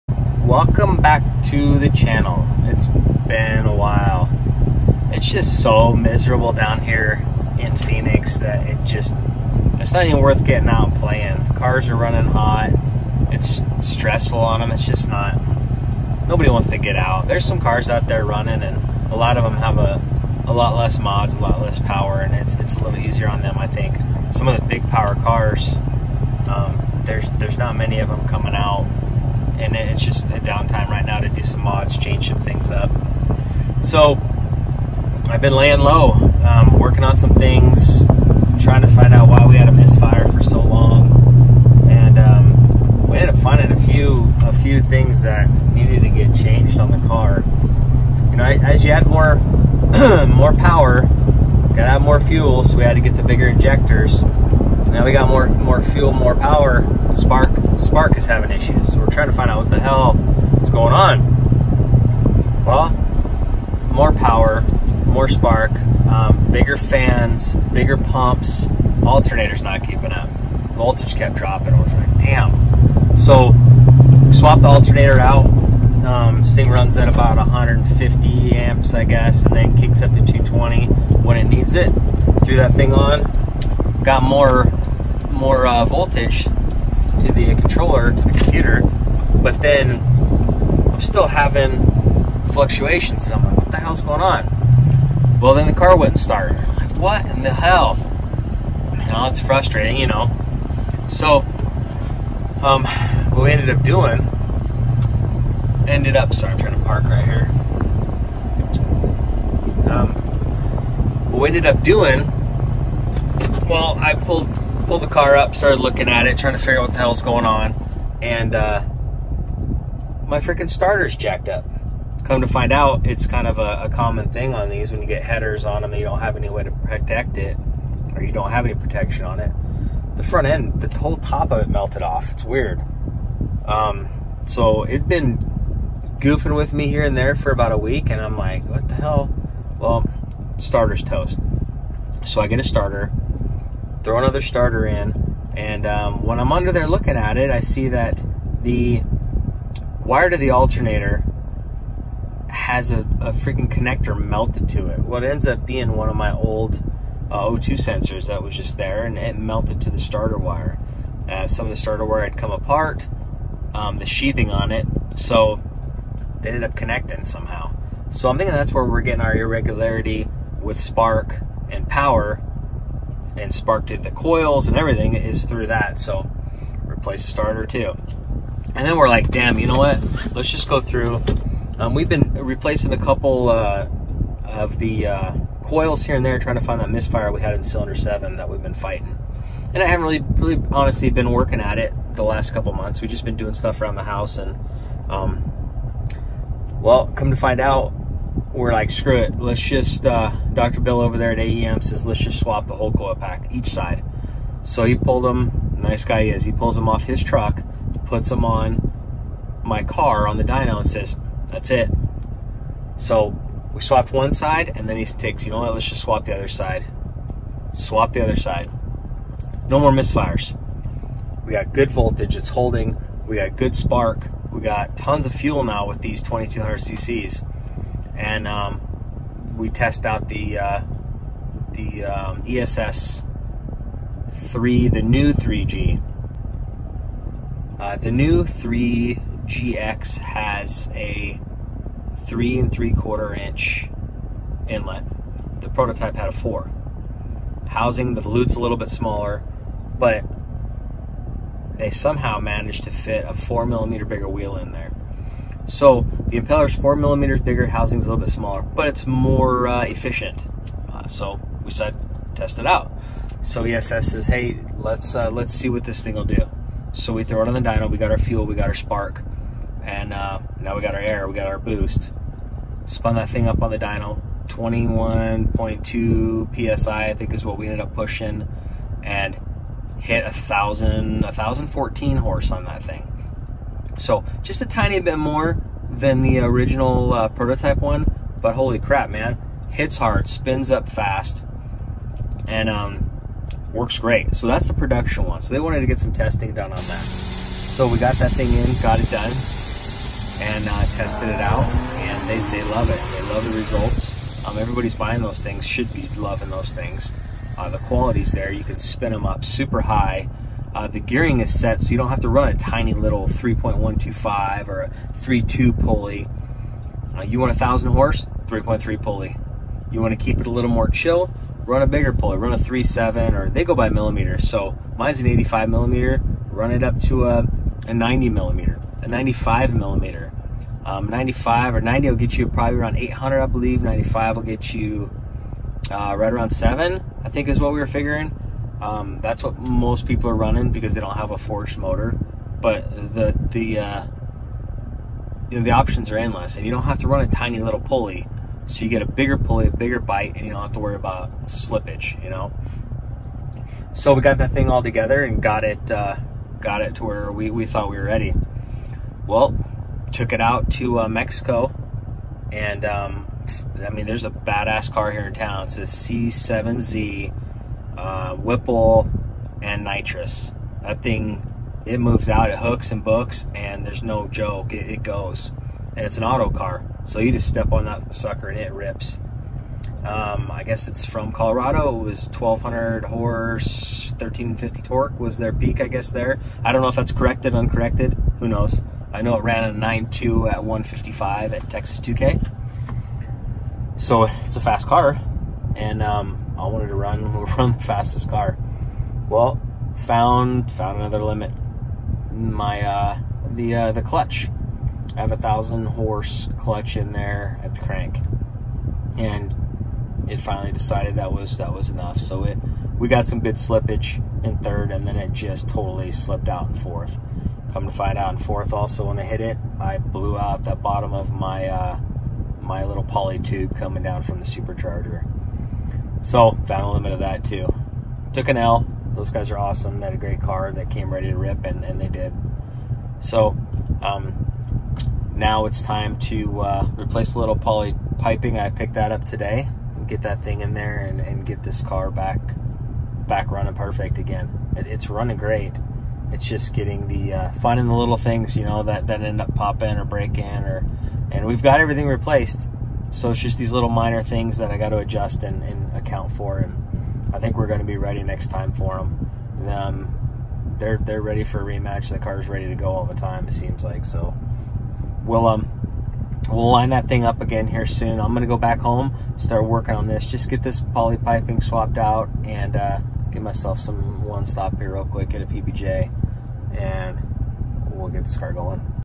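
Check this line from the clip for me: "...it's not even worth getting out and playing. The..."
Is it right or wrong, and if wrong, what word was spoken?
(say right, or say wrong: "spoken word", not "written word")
right.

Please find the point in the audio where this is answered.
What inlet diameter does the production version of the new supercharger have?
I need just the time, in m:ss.
4:02.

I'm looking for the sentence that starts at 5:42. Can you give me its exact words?
But the the uh, you know, the options are endless, and you don't have to run a tiny little pulley.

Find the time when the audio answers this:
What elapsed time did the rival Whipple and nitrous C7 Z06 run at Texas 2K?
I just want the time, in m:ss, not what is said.
6:29.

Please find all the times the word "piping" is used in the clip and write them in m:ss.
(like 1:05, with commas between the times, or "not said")
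7:18, 7:51.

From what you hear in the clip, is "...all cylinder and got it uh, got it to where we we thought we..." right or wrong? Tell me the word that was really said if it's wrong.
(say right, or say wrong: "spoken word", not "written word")
wrong: "together", not "cylinder".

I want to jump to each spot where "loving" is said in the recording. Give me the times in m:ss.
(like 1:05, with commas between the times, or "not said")
5:06.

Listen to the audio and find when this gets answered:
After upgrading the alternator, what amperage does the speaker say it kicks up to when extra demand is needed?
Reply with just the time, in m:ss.
1:20.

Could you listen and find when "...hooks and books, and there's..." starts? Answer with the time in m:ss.
6:12.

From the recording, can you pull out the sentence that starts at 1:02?
Well, more power, more spark, um, bigger fans, bigger pumps, alternator's not keeping up.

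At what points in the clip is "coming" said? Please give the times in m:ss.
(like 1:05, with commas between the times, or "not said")
0:28, 7:03.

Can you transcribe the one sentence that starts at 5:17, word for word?
Uh, you want a 1,000 horse, 3.3 pulley.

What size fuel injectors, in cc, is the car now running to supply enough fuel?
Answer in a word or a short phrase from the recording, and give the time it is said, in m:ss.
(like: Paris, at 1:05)
2200 cc, at 3:46.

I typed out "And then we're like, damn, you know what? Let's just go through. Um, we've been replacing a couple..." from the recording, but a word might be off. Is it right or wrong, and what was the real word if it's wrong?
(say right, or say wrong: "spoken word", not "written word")
right.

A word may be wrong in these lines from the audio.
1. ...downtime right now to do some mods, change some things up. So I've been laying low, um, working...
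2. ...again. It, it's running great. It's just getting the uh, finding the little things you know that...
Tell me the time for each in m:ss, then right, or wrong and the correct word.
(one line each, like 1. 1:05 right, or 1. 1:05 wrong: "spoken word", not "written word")
1. 0:30 right
2. 7:24 right.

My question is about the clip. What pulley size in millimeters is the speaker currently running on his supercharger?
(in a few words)
85 millimeters.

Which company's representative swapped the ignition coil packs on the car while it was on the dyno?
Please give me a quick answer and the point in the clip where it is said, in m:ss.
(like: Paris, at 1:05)
AEM, at 3:21.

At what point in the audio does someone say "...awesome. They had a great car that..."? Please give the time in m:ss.
7:09.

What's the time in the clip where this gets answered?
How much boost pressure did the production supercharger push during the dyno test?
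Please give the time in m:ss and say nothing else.
4:34.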